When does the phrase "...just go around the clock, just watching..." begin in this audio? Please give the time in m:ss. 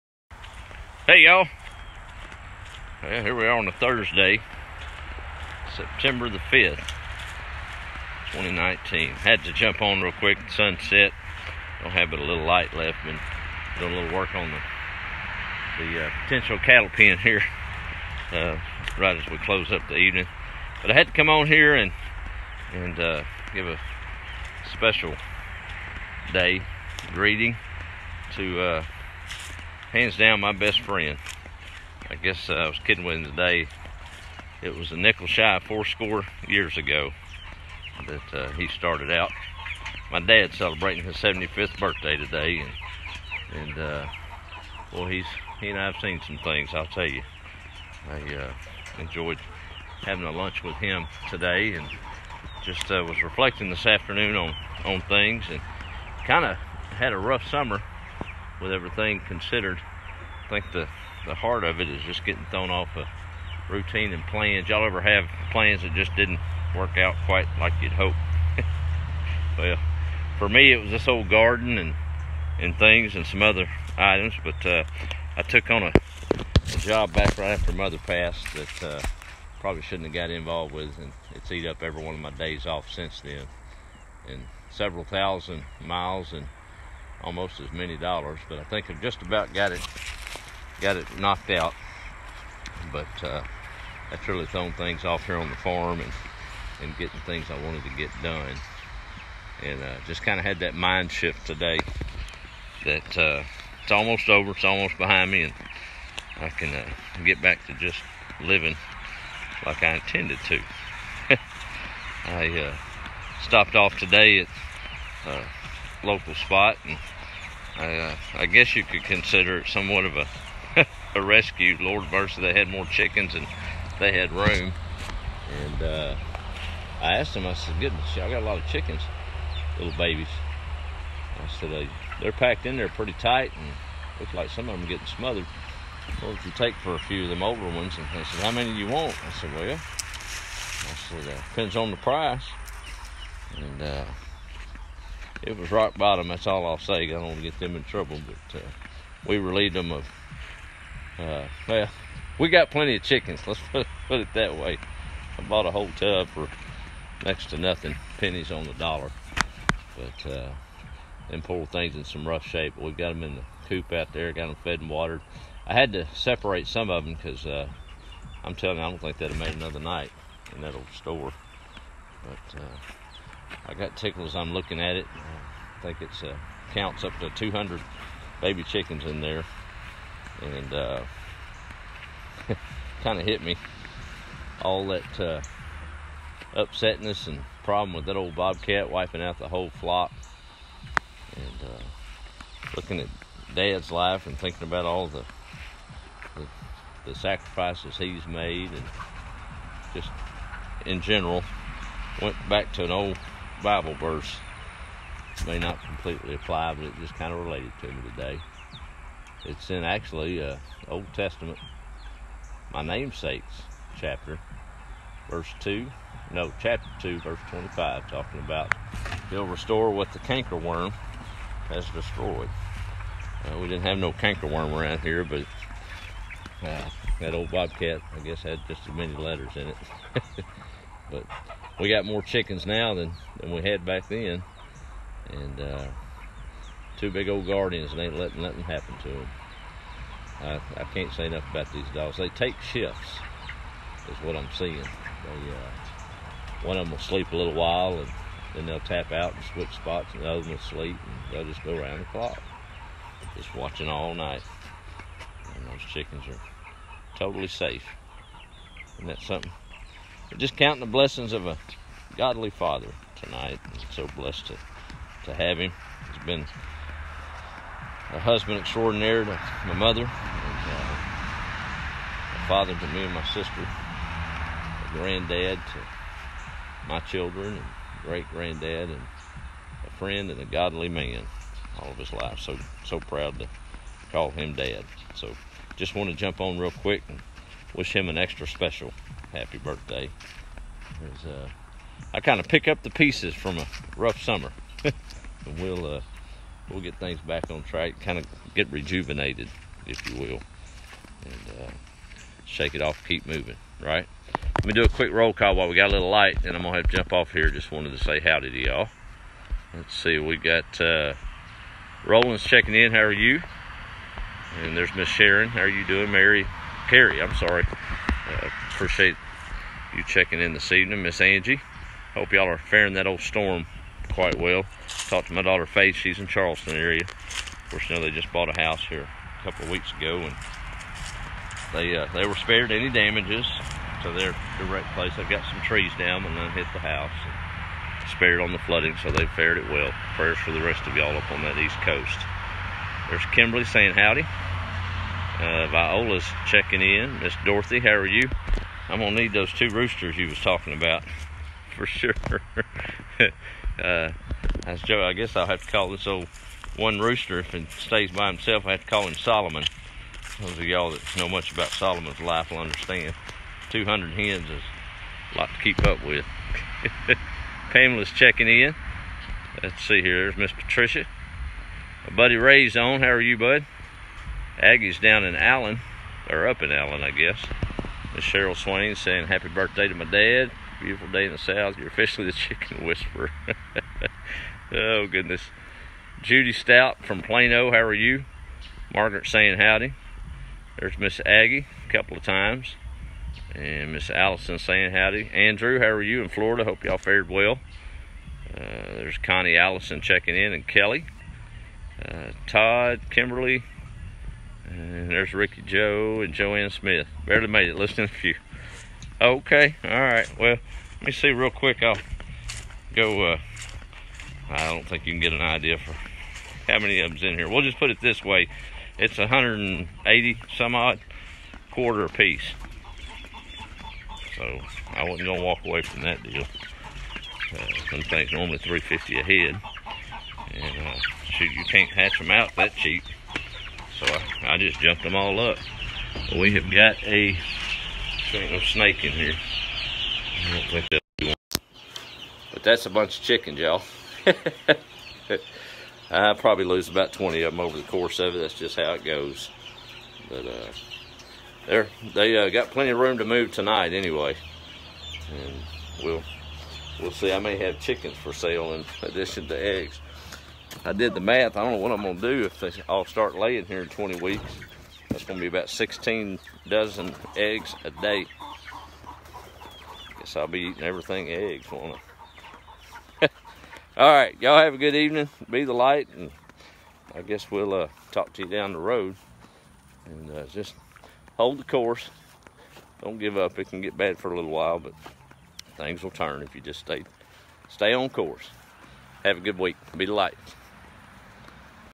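4:11.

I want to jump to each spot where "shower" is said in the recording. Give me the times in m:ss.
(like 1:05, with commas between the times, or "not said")
not said.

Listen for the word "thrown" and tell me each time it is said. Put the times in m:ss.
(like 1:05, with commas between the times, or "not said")
1:02, 1:34.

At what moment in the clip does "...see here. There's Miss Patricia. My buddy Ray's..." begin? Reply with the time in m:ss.
6:09.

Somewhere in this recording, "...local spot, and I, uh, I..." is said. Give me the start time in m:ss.
1:56.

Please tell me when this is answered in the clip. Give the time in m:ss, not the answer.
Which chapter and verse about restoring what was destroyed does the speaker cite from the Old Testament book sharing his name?
3:36.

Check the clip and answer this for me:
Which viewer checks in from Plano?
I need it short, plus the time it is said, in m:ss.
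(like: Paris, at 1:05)
Judy Stout, at 6:26.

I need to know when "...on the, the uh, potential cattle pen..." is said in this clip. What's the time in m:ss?
0:14.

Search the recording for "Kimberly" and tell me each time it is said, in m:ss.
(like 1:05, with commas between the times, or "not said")
5:43, 6:43.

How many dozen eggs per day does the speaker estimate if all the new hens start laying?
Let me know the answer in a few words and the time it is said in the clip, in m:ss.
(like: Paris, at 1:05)
16, at 7:45.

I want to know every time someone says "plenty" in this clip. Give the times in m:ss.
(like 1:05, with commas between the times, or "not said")
2:32, 7:32.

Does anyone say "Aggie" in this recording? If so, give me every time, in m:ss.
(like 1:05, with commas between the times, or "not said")
6:14, 6:31.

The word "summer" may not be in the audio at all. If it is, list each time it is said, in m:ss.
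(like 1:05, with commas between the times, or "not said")
0:57, 4:54.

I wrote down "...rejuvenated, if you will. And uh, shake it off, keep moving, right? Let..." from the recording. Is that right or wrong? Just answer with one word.
right.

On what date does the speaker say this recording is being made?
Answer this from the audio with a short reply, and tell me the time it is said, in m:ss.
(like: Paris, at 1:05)
September 5th, 2019, at 0:05.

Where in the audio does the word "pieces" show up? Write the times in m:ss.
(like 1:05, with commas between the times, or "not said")
4:52, 7:02.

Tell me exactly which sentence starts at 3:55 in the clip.
And uh, two big old guardians, and ain't letting nothing happen to them.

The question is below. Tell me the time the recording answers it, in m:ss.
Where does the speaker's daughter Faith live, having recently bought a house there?
5:26.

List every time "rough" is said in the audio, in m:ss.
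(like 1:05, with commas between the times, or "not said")
0:57, 2:42, 4:53.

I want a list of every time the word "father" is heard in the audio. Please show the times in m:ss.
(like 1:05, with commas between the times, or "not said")
4:22, 4:32.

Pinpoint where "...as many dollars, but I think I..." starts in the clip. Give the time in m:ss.
1:27.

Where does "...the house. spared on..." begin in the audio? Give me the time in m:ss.
5:36.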